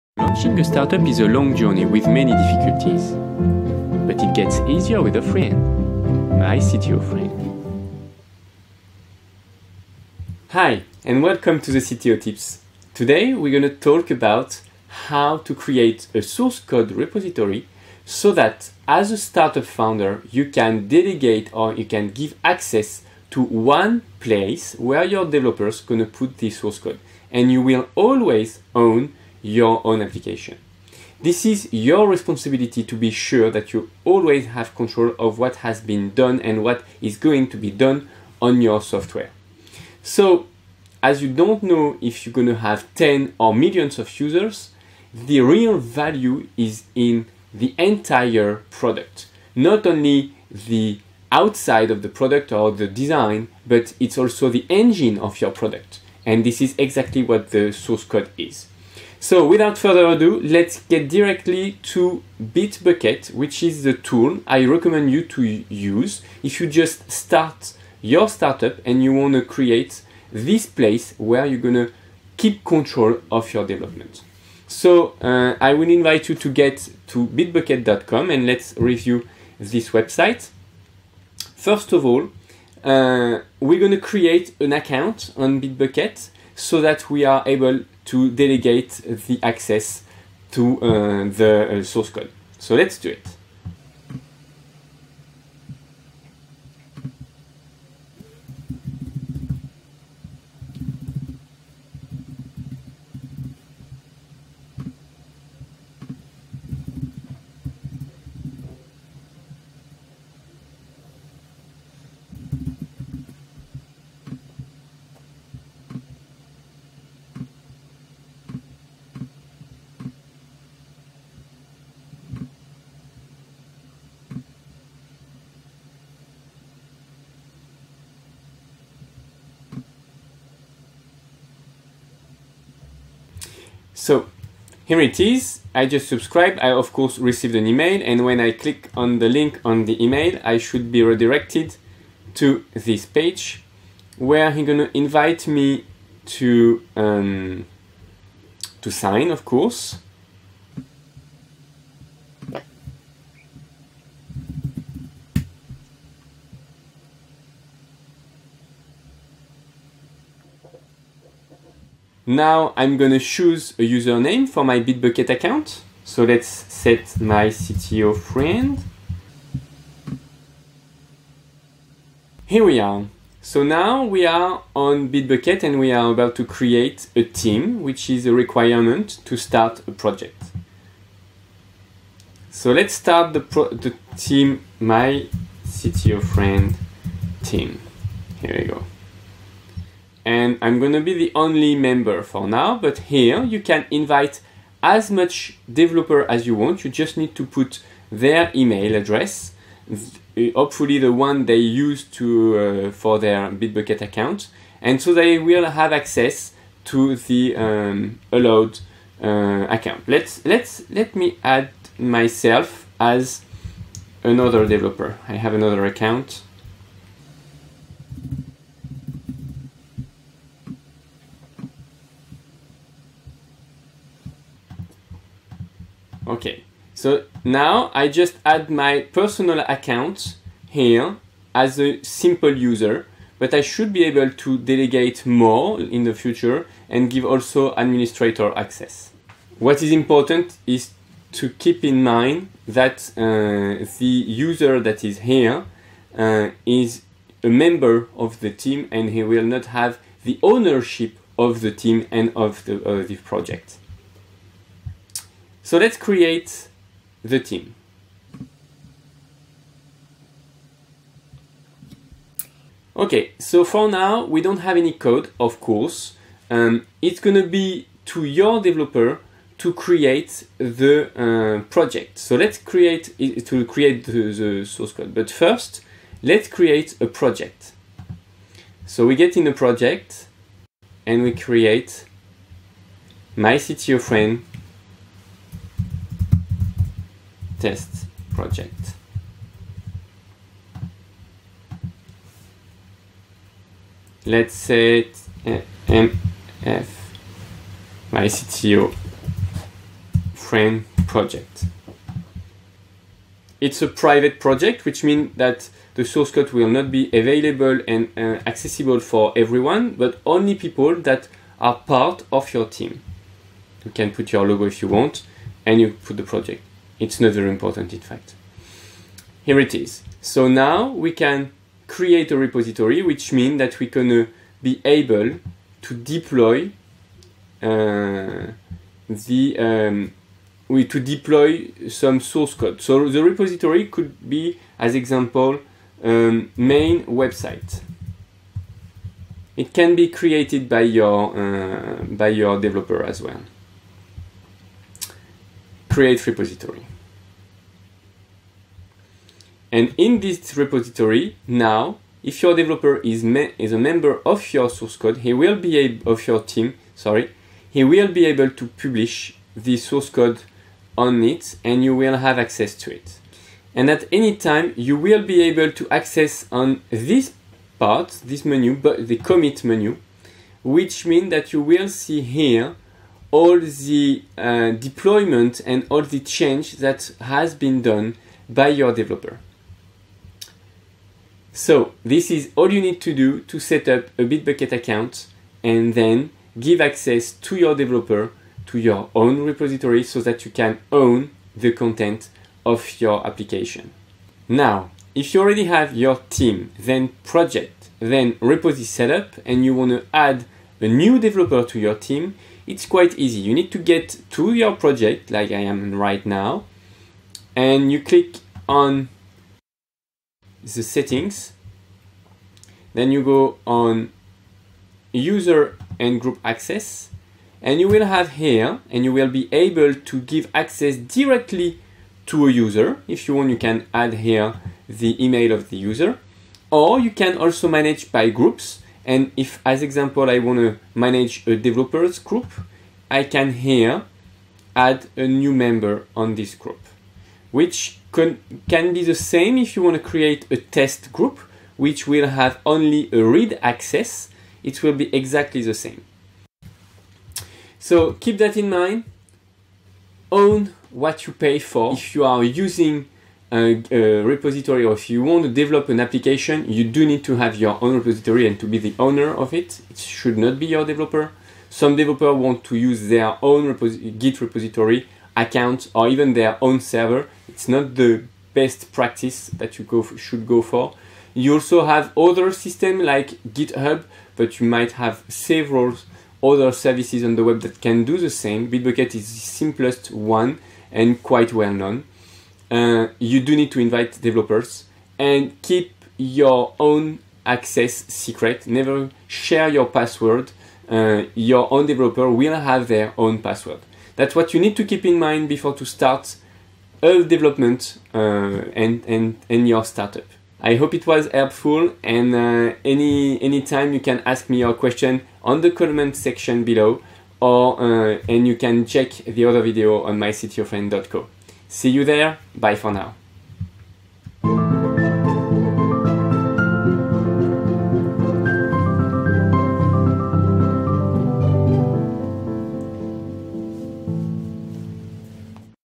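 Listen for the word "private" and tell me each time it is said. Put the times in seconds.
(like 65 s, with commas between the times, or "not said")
303 s.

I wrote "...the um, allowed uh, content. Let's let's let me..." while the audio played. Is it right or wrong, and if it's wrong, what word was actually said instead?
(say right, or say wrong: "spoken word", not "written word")
wrong: "account", not "content".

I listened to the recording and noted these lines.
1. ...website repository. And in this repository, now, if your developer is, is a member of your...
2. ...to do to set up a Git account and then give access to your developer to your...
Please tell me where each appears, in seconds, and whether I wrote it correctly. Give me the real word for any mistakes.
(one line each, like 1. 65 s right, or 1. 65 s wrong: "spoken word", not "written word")
1. 345 s wrong: "create", not "website"
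2. 383 s wrong: "Bitbucket", not "Git".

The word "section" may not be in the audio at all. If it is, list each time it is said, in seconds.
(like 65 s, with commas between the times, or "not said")
506 s.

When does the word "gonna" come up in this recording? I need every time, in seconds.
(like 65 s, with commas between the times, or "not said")
144 s, 162 s, 267 s.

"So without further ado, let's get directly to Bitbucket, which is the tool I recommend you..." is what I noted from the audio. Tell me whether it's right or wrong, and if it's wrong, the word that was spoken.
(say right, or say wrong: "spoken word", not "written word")
right.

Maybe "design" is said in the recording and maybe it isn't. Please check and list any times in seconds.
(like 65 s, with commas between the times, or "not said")
52 s.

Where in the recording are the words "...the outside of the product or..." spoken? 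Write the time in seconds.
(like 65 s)
50 s.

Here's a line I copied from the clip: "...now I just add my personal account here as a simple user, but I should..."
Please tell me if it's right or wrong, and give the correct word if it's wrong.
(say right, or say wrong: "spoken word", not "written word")
right.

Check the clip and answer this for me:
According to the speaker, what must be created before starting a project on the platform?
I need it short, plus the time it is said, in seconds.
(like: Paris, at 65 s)
a team, at 177 s.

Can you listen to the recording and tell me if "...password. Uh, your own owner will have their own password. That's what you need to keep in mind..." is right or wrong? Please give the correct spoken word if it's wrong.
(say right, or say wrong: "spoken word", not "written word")
wrong: "developer", not "owner".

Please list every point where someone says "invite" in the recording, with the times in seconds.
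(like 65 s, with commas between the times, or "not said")
75 s, 144 s, 193 s, 483 s.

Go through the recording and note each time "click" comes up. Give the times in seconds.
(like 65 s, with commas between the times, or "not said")
138 s, 408 s.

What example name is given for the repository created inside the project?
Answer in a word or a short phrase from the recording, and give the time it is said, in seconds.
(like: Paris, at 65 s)
main website, at 336 s.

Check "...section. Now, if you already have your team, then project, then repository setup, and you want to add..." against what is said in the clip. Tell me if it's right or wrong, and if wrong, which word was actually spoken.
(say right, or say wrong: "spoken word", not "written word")
wrong: "application", not "section".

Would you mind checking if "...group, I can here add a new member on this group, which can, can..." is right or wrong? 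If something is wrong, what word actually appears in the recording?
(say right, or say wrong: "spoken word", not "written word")
right.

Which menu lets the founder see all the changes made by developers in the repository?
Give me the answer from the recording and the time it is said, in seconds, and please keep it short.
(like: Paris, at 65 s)
commit menu, at 369 s.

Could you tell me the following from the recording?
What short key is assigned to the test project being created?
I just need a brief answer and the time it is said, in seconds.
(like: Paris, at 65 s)
MF, at 296 s.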